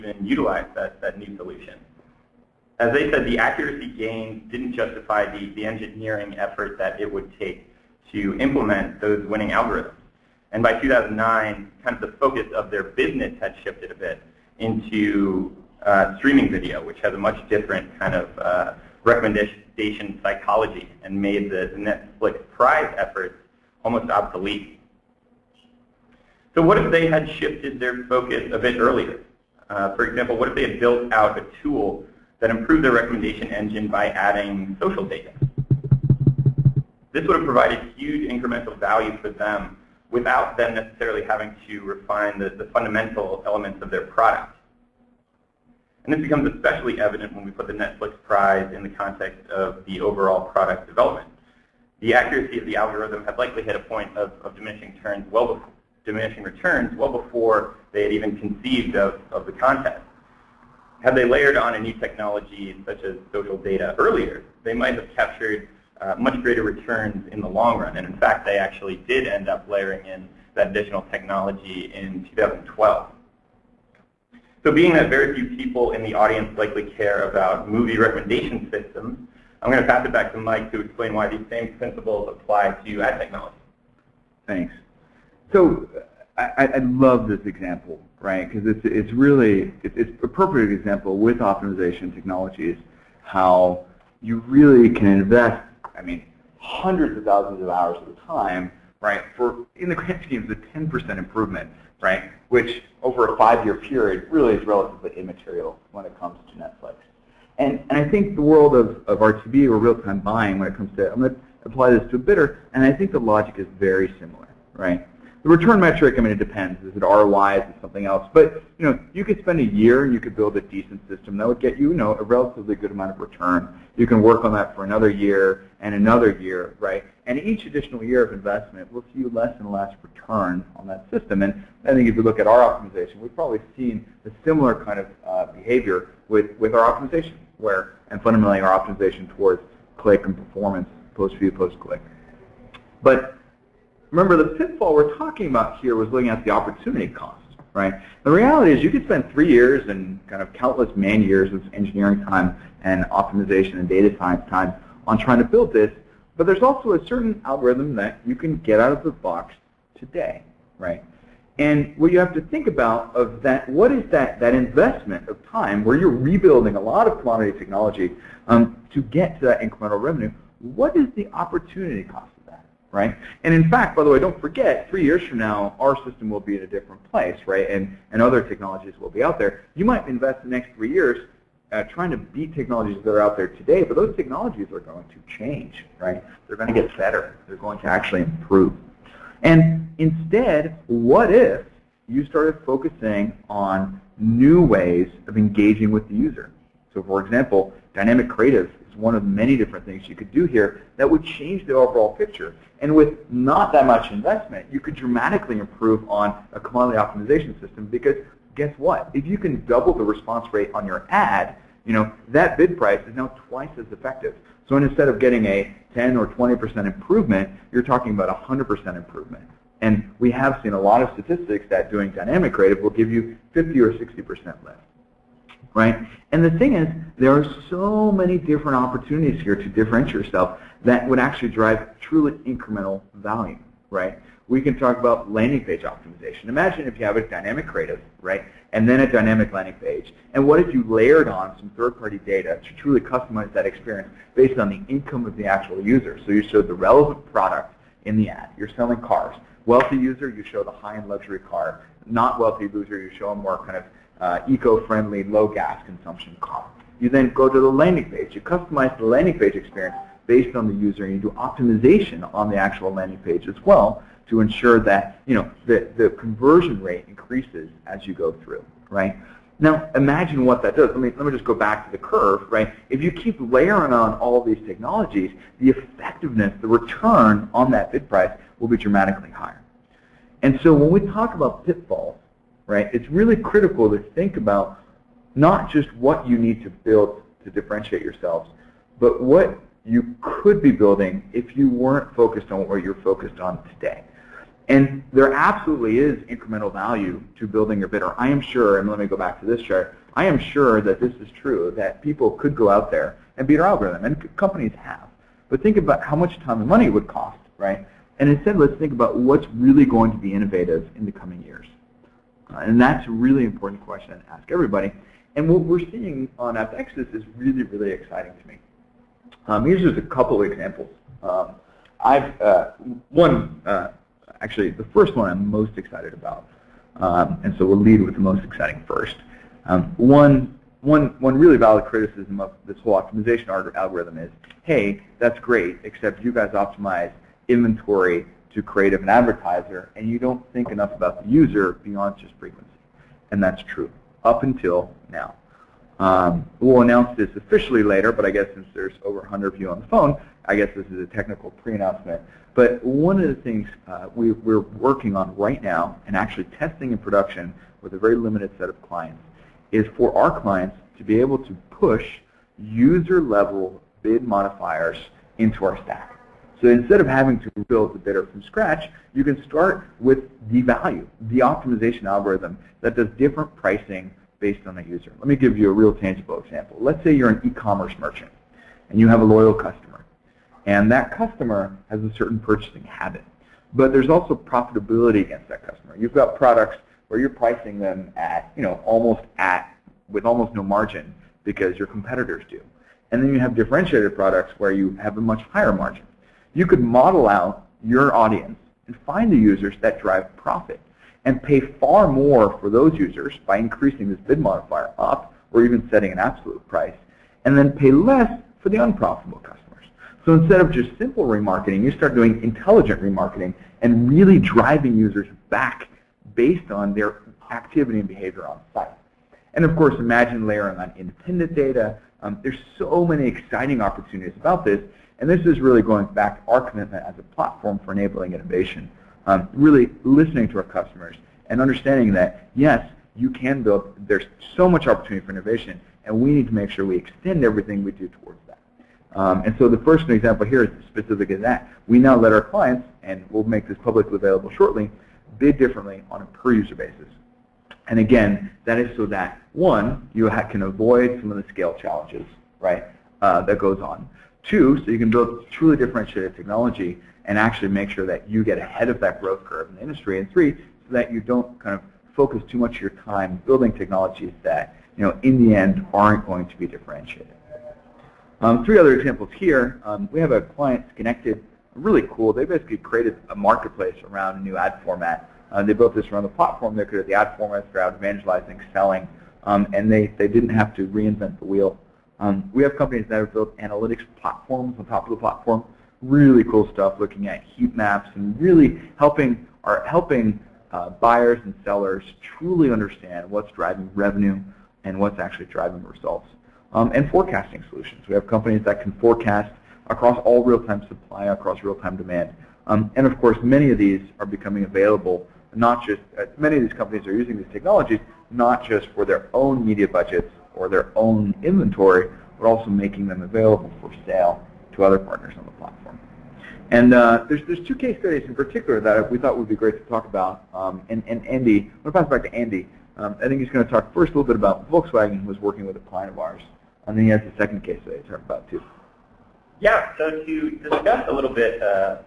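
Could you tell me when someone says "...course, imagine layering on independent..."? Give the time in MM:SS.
06:59.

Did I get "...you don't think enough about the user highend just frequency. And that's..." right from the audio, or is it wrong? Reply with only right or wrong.
wrong.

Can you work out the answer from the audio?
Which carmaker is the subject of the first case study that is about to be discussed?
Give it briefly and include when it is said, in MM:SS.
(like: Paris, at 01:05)
Volkswagen, at 08:44.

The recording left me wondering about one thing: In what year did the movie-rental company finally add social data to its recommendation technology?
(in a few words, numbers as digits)
2012.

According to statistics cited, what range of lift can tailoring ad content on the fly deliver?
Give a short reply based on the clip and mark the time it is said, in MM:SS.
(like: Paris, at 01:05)
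50 or 60%, at 03:43.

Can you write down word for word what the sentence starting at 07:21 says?
We now let our clients, and we'll make this publicly available shortly, bid differently on a per user basis.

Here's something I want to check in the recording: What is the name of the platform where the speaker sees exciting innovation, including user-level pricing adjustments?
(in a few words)
AppNexus.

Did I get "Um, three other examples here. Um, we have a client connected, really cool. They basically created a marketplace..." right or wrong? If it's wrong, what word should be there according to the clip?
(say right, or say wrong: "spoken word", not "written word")
right.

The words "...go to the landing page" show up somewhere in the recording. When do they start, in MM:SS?
04:17.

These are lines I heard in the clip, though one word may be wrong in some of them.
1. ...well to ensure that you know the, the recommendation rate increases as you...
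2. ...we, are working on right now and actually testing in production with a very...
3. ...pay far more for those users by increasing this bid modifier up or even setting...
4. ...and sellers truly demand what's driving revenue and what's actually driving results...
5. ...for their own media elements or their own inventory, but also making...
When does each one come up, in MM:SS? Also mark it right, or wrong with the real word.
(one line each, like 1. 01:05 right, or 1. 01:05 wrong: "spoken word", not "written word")
1. 04:23 wrong: "conversion", not "recommendation"
2. 05:54 right
3. 06:41 right
4. 08:11 wrong: "understand", not "demand"
5. 08:28 wrong: "budgets", not "elements".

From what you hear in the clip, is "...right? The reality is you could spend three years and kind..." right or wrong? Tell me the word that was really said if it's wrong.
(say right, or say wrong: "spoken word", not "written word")
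right.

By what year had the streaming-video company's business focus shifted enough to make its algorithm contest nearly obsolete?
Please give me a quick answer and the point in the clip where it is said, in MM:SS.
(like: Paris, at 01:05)
2009, at 00:10.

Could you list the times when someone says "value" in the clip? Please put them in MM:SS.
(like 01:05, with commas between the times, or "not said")
00:38, 03:53, 04:56, 06:10.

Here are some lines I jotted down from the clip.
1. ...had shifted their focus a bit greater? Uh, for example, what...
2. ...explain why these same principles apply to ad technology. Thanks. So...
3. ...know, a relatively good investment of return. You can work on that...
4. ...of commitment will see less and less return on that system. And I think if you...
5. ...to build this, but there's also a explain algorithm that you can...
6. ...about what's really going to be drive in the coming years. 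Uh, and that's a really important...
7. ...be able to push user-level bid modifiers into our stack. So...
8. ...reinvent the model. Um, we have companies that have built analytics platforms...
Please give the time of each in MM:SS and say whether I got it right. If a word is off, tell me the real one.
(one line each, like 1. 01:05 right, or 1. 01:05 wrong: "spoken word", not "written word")
1. 00:27 wrong: "earlier", not "greater"
2. 01:20 right
3. 02:01 wrong: "amount", not "investment"
4. 02:08 wrong: "investment", not "commitment"
5. 02:35 wrong: "certain", not "explain"
6. 05:08 wrong: "innovative", not "drive"
7. 06:01 right
8. 08:00 wrong: "wheel", not "model".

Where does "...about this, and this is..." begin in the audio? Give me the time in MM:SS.
07:04.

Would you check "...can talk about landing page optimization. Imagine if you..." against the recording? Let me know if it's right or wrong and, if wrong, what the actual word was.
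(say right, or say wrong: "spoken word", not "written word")
right.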